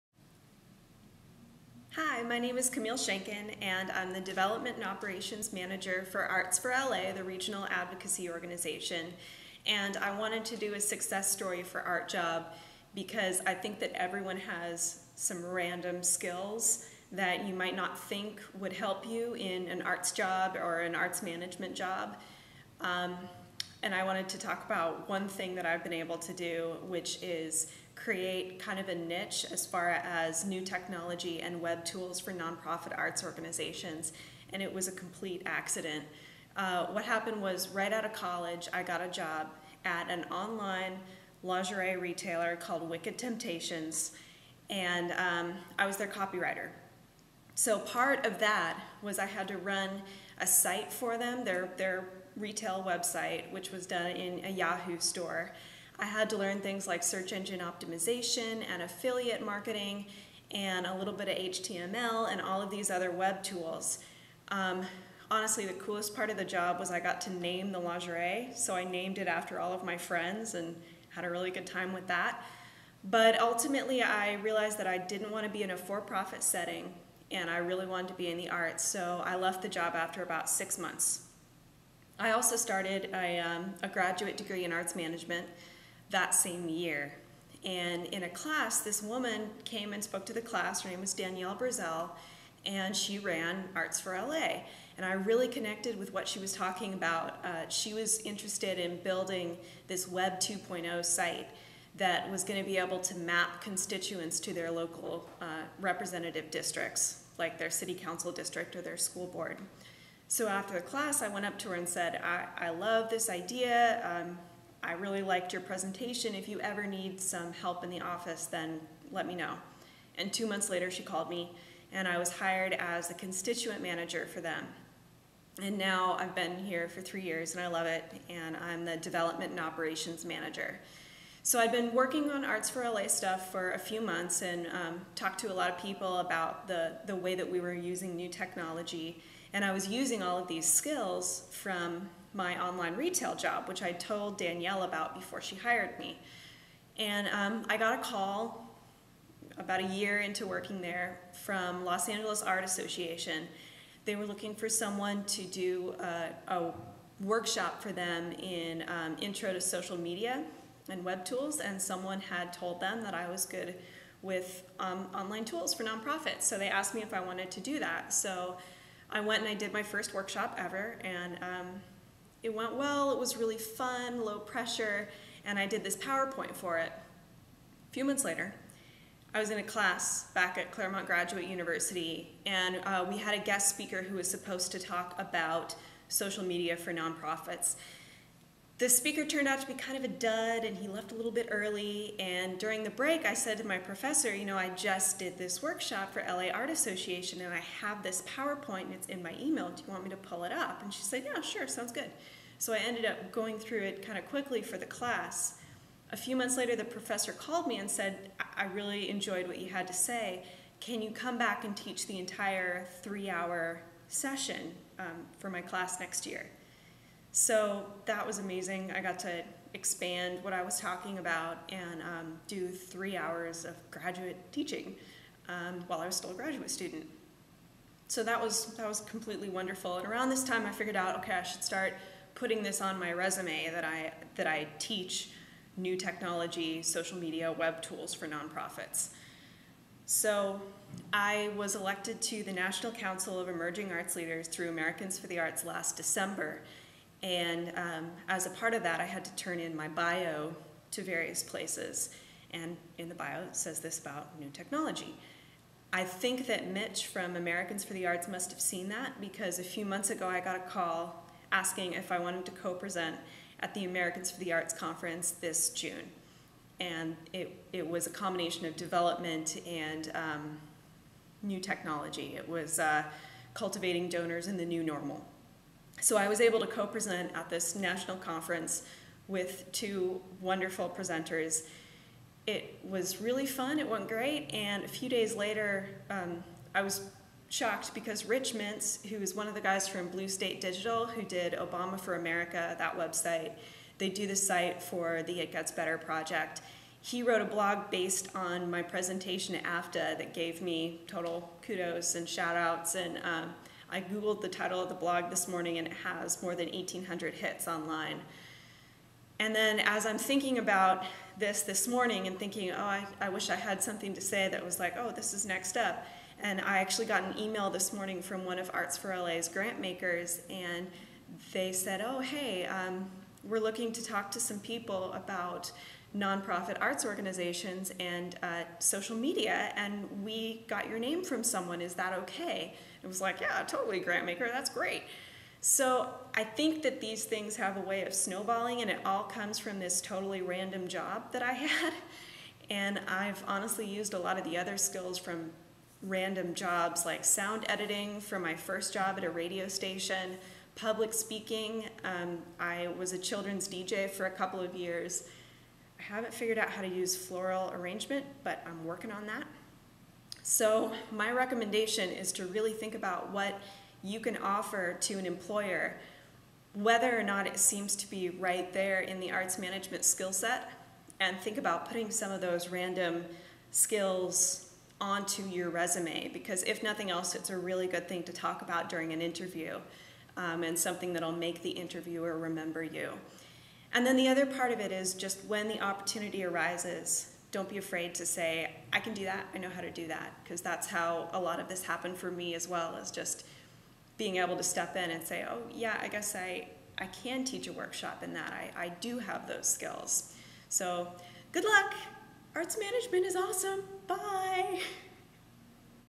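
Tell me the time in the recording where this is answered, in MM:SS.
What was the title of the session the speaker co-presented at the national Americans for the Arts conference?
04:33.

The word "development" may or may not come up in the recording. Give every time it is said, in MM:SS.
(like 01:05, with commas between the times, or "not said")
00:04, 02:08, 04:28.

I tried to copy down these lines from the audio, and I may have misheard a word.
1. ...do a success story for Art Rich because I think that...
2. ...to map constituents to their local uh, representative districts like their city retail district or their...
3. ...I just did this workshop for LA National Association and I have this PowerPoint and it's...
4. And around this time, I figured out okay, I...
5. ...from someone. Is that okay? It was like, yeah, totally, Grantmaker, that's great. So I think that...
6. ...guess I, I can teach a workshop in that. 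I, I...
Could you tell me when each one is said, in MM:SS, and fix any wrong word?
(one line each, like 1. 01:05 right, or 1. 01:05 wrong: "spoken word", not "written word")
1. 00:10 wrong: "Job", not "Rich"
2. 01:42 wrong: "council", not "retail"
3. 03:14 wrong: "Art", not "National"
4. 03:49 right
5. 05:31 right
6. 06:36 right.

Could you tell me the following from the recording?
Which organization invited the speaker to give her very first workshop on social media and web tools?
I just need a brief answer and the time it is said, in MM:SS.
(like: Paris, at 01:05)
Los Angeles Art Association, at 02:31.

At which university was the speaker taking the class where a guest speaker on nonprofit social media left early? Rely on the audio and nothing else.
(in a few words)
Claremont Graduate University.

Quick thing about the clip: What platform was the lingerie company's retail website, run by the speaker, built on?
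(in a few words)
Yahoo store.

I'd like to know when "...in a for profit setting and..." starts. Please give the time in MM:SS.
01:15.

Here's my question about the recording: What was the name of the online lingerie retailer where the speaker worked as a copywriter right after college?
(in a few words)
Wicked Temptations.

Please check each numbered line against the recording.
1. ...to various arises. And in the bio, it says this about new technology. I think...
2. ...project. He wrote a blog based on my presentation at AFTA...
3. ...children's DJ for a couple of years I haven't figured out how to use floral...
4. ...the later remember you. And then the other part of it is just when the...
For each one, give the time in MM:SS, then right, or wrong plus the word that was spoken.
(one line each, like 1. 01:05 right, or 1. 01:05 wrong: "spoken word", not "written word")
1. 04:10 wrong: "places", not "arises"
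2. 04:55 right
3. 05:53 right
4. 06:21 wrong: "interviewer", not "later".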